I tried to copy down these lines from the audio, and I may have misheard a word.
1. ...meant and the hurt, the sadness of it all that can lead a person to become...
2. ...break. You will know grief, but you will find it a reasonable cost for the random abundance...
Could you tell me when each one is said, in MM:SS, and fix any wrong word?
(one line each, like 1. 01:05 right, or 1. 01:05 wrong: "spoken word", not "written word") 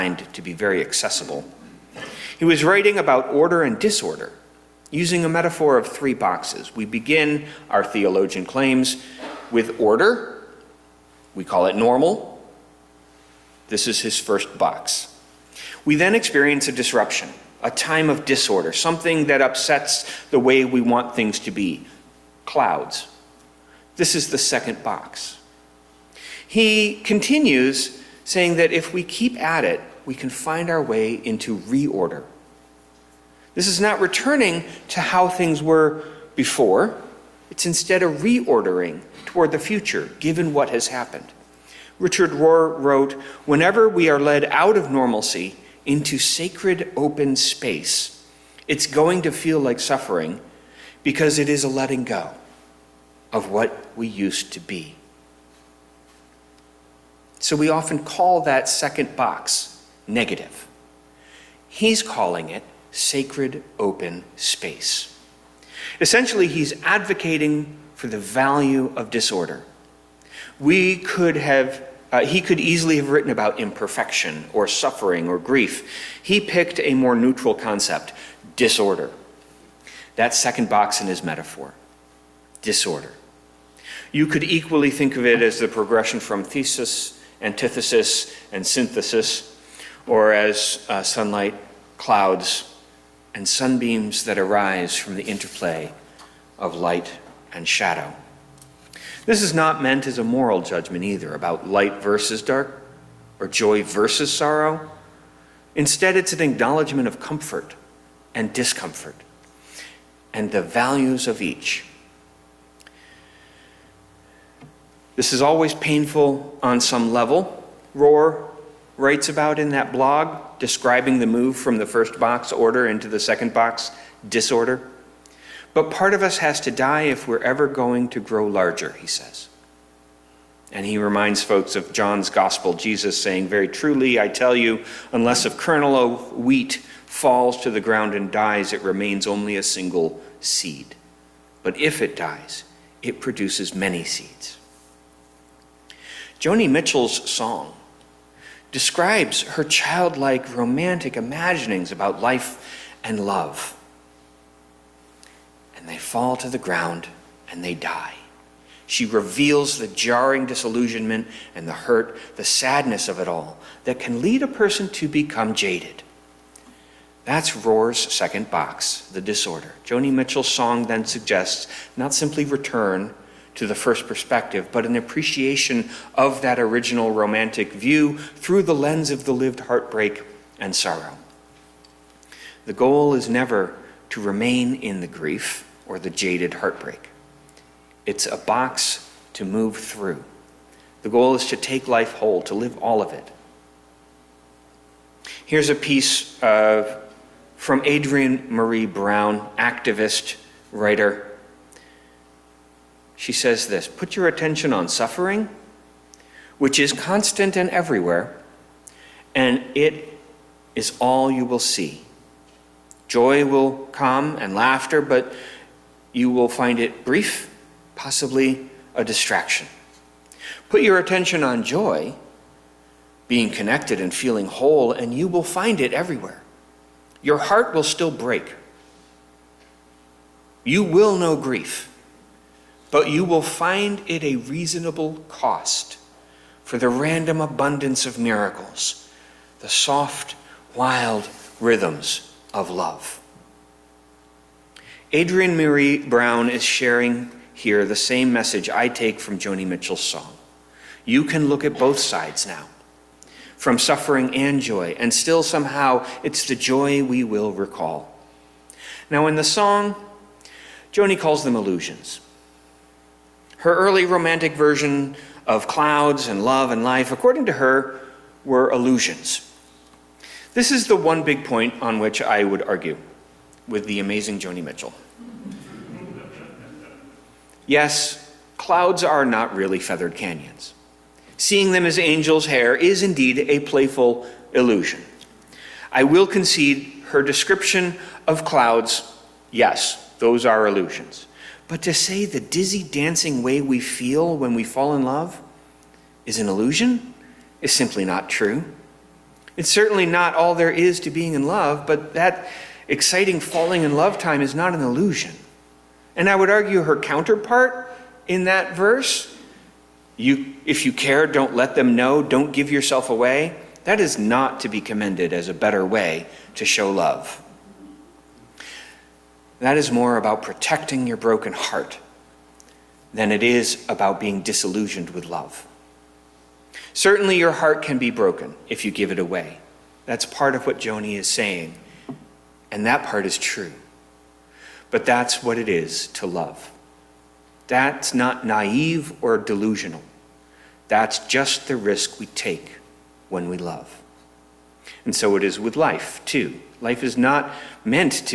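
1. 02:40 wrong: "disillusionment", not "meant"
2. 03:48 right.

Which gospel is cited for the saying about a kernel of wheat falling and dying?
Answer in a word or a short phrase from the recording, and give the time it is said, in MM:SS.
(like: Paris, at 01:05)
John's gospel, at 02:11.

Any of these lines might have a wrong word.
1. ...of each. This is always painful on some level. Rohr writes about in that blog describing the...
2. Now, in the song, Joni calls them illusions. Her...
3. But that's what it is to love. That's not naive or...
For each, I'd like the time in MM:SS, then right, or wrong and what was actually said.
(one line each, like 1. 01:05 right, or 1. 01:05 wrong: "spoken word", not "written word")
1. 01:51 right
2. 04:19 right
3. 05:34 right.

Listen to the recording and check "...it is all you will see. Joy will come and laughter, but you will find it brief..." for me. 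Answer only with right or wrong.
right.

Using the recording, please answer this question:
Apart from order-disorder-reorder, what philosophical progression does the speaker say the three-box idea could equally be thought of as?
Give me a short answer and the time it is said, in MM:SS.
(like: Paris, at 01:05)
thesis, antithesis, and synthesis, at 01:26.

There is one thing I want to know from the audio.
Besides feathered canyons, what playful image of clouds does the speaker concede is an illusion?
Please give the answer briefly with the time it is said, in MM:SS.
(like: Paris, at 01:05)
angels' hair, at 04:41.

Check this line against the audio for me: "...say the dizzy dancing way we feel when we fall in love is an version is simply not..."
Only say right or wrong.
wrong.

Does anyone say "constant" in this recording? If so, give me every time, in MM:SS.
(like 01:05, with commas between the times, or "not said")
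03:26.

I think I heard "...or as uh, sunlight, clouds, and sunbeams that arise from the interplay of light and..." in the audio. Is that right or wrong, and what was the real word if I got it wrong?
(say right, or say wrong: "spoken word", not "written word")
right.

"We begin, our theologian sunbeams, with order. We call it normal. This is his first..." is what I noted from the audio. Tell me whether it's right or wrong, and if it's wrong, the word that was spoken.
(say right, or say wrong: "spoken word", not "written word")
wrong: "claims", not "sunbeams".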